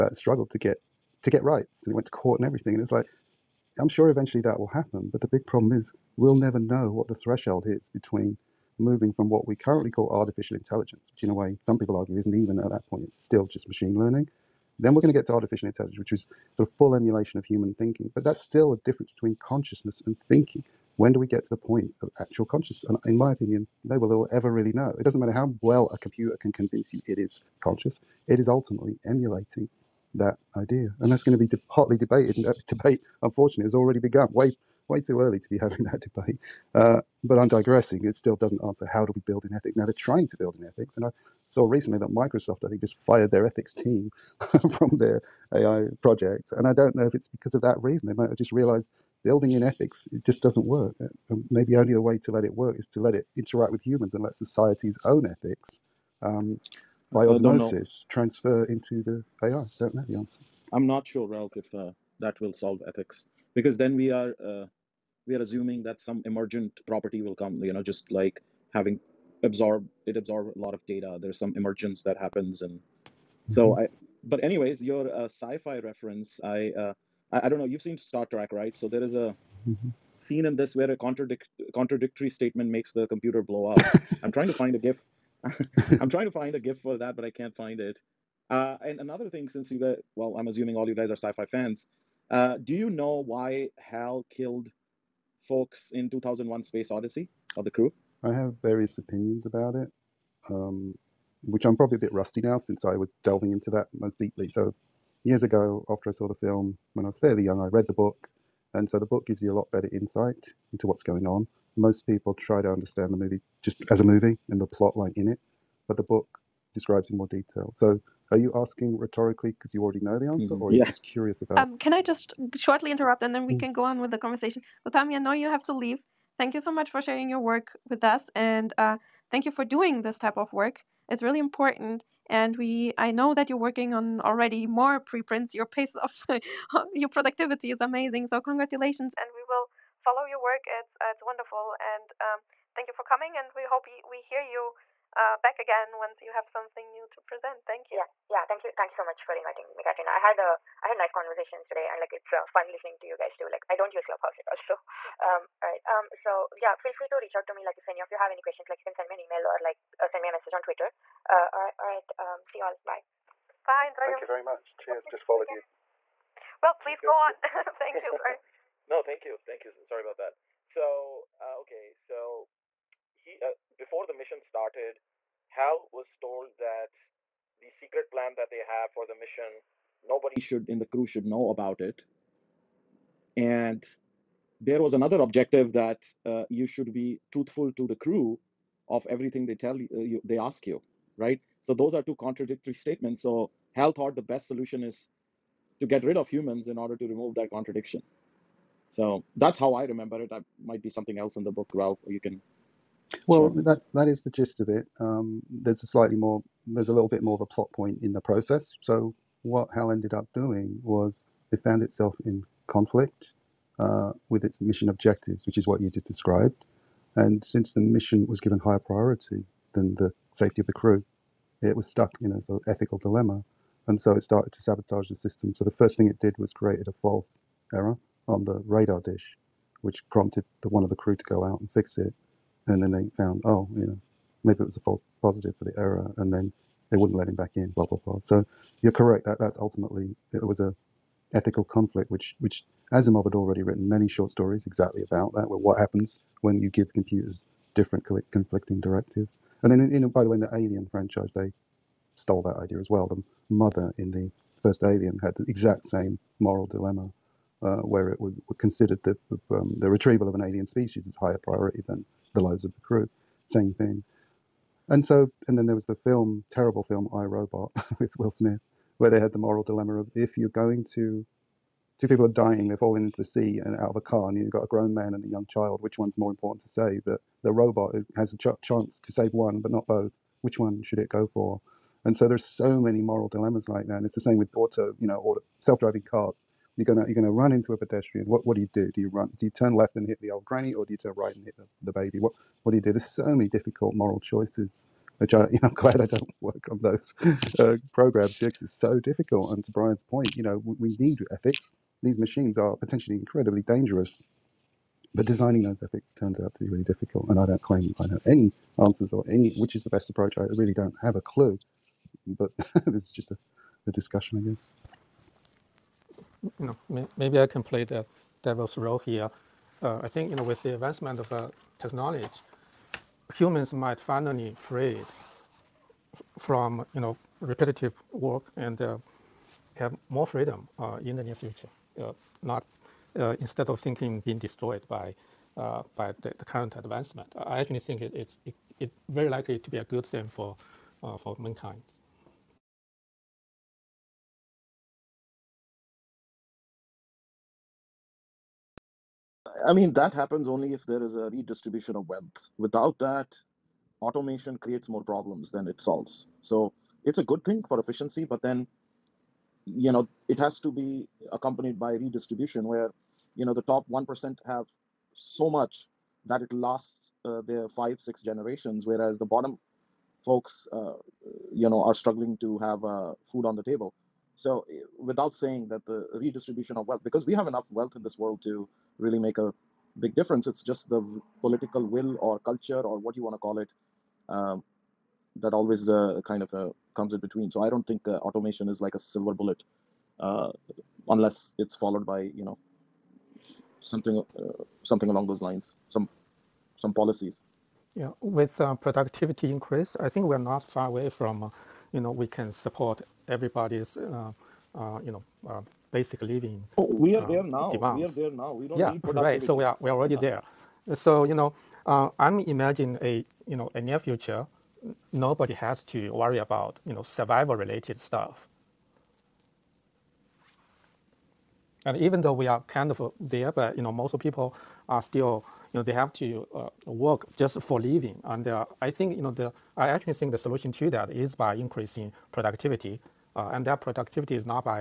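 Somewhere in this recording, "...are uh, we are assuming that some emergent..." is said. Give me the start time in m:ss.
1:04.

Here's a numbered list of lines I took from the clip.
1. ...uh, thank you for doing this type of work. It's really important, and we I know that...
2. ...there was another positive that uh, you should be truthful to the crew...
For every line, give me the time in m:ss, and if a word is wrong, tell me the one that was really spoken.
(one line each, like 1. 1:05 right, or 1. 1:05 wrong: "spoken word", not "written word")
1. 2:08 right
2. 3:04 wrong: "objective", not "positive".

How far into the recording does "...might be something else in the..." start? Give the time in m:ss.
3:20.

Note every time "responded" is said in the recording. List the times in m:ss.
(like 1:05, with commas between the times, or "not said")
not said.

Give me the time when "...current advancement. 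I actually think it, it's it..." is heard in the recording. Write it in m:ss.
5:36.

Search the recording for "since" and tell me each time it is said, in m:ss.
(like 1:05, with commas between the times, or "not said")
1:29, 1:42, 3:37.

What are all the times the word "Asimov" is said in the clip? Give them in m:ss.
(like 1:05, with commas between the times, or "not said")
4:02.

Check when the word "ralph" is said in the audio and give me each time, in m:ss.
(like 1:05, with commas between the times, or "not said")
1:01, 3:21.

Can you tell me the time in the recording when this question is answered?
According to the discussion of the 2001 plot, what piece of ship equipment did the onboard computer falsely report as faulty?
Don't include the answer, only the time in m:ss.
3:48.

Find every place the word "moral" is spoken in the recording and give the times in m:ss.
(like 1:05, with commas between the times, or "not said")
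4:16, 4:29, 4:43, 4:53.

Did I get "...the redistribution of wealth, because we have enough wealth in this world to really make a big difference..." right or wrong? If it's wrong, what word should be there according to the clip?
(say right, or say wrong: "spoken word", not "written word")
right.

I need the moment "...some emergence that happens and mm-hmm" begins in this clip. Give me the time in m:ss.
1:11.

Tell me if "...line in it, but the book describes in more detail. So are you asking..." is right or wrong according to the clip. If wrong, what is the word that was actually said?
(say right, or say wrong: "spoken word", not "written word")
right.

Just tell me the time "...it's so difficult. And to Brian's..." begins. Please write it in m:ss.
4:58.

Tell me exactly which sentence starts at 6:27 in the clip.
So, I don't think uh, automation is like a silver bullet.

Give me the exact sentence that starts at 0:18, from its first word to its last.
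But that's still a difference between consciousness and thinking.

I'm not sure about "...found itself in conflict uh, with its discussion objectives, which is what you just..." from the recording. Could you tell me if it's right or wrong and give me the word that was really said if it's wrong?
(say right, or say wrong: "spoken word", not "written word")
wrong: "mission", not "discussion".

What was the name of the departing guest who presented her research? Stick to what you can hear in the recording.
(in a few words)
Gowthami.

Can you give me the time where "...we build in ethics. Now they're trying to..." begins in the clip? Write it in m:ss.
0:39.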